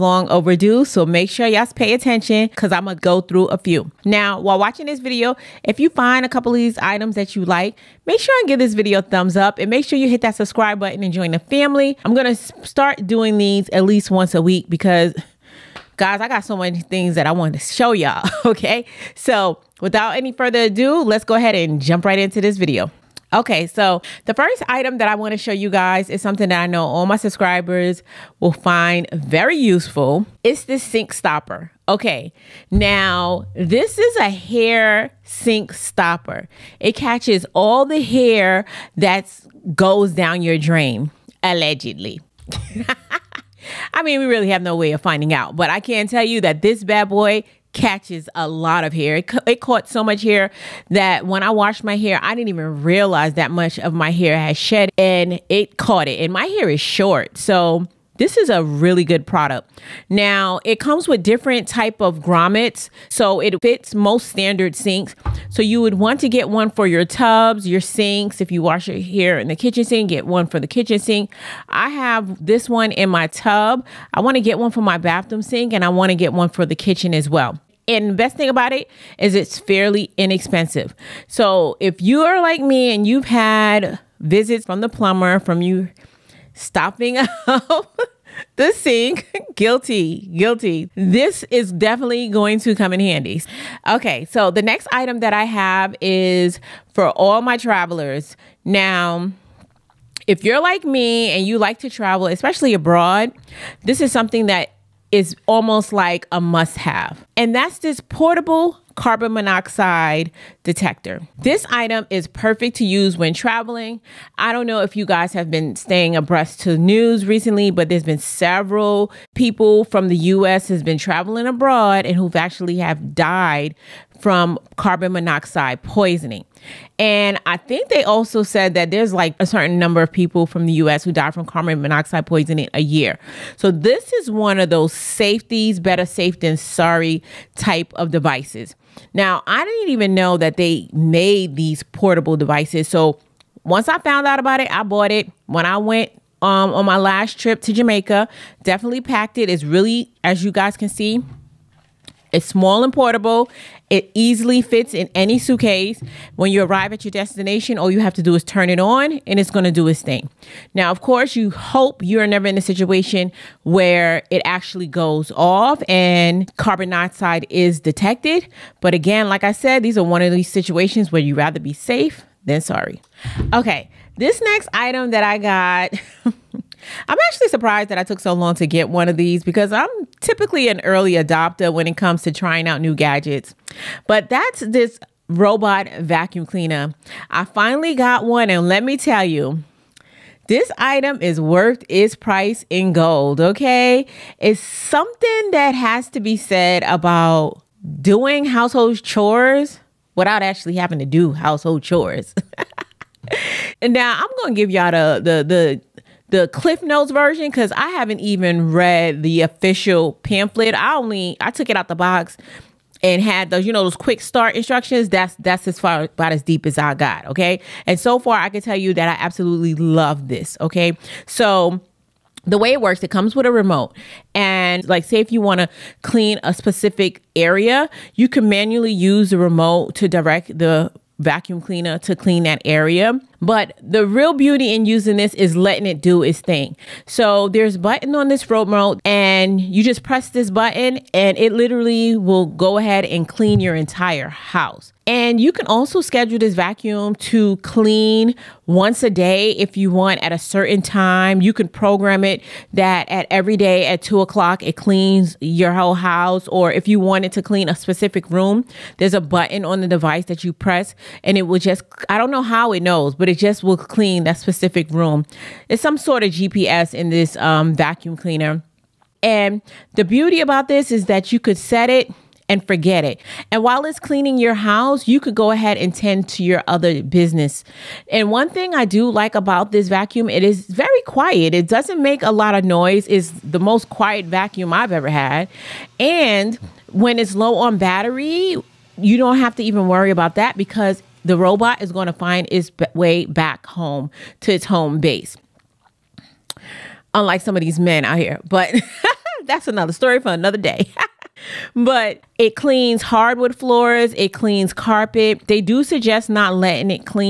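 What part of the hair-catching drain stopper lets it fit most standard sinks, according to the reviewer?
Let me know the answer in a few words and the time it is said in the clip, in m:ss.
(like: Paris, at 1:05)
Grommets, at 1:02.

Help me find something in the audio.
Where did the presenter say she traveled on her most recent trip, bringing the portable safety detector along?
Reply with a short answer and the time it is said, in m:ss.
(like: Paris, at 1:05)
Jamaica, at 2:27.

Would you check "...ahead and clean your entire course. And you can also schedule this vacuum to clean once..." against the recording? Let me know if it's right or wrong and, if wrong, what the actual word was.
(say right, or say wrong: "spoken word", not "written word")
wrong: "house", not "course".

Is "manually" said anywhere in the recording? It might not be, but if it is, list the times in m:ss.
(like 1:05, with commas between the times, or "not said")
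3:48.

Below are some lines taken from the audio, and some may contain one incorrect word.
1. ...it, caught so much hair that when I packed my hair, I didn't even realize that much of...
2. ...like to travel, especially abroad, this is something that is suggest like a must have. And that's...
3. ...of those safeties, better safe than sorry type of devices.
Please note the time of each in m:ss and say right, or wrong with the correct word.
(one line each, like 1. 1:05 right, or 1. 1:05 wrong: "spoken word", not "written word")
1. 0:49 wrong: "washed", not "packed"
2. 1:41 wrong: "almost", not "suggest"
3. 2:14 right.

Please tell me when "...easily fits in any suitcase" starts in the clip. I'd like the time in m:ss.
2:34.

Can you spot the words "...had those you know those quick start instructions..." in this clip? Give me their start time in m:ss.
3:33.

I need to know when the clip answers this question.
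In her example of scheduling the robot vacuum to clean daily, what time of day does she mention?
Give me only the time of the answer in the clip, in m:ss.
4:14.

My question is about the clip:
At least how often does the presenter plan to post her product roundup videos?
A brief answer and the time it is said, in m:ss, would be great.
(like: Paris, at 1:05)
Once a week, at 0:14.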